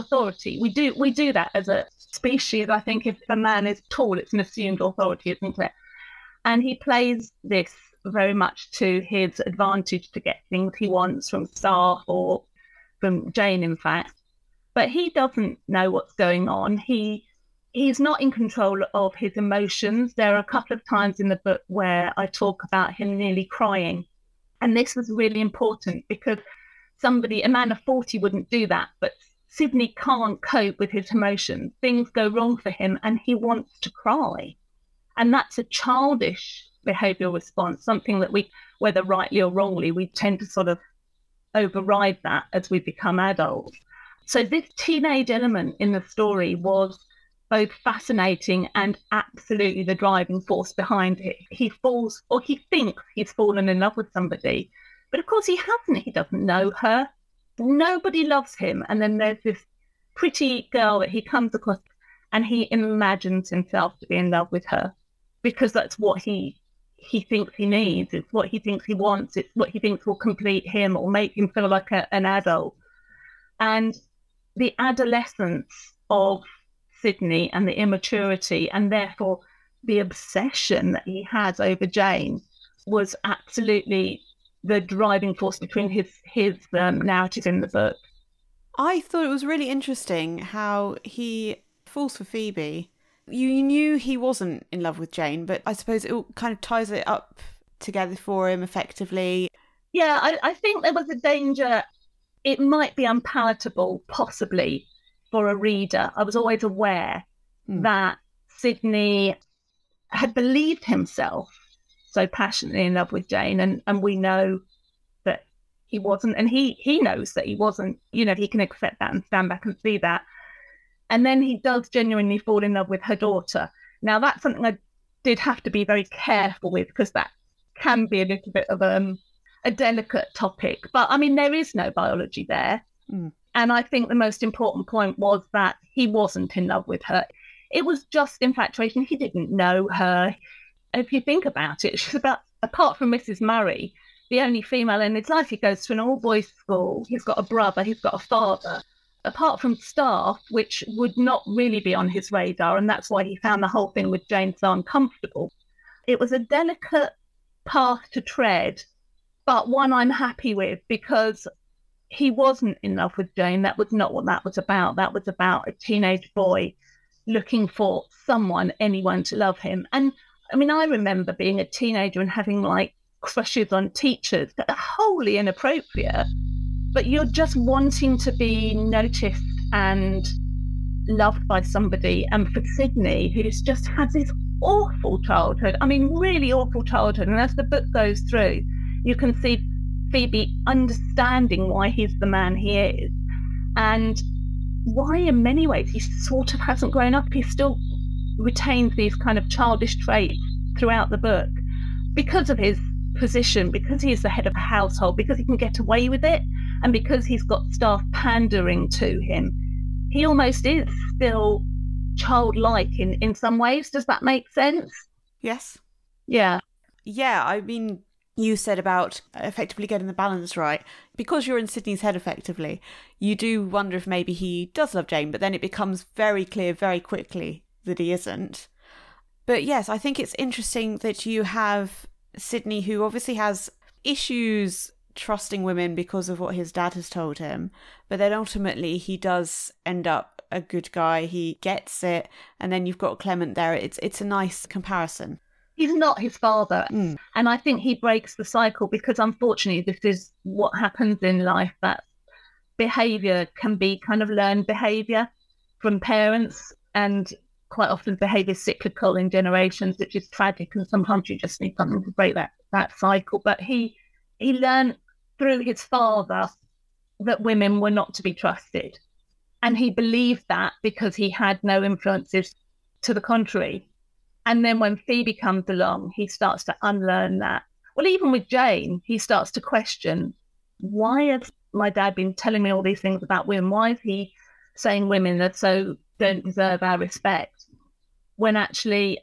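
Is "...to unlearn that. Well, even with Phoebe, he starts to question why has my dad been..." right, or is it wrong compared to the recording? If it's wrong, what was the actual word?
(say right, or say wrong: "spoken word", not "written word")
wrong: "Jane", not "Phoebe".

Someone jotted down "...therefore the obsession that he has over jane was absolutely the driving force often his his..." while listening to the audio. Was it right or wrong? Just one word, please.
wrong.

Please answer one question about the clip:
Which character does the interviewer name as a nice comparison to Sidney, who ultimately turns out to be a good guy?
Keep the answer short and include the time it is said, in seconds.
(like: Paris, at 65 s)
Clement, at 243 s.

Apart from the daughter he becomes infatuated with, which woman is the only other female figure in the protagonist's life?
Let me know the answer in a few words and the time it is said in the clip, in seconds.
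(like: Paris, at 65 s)
Mrs. Murray, at 143 s.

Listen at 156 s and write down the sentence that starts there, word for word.
It was a delicate path to tread, but one I'm happy with because he wasn't in love with Jane.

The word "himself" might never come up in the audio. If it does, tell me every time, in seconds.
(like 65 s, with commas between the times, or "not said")
63 s, 110 s.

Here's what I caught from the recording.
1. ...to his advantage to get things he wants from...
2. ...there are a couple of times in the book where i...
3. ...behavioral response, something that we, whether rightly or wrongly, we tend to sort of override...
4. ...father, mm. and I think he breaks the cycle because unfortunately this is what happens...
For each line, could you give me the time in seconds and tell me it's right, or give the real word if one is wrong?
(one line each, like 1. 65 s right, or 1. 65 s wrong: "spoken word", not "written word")
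1. 8 s right
2. 20 s right
3. 36 s right
4. 246 s right.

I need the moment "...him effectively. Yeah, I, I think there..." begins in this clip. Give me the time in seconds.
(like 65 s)
98 s.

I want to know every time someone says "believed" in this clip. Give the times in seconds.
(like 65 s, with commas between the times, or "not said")
110 s, 269 s.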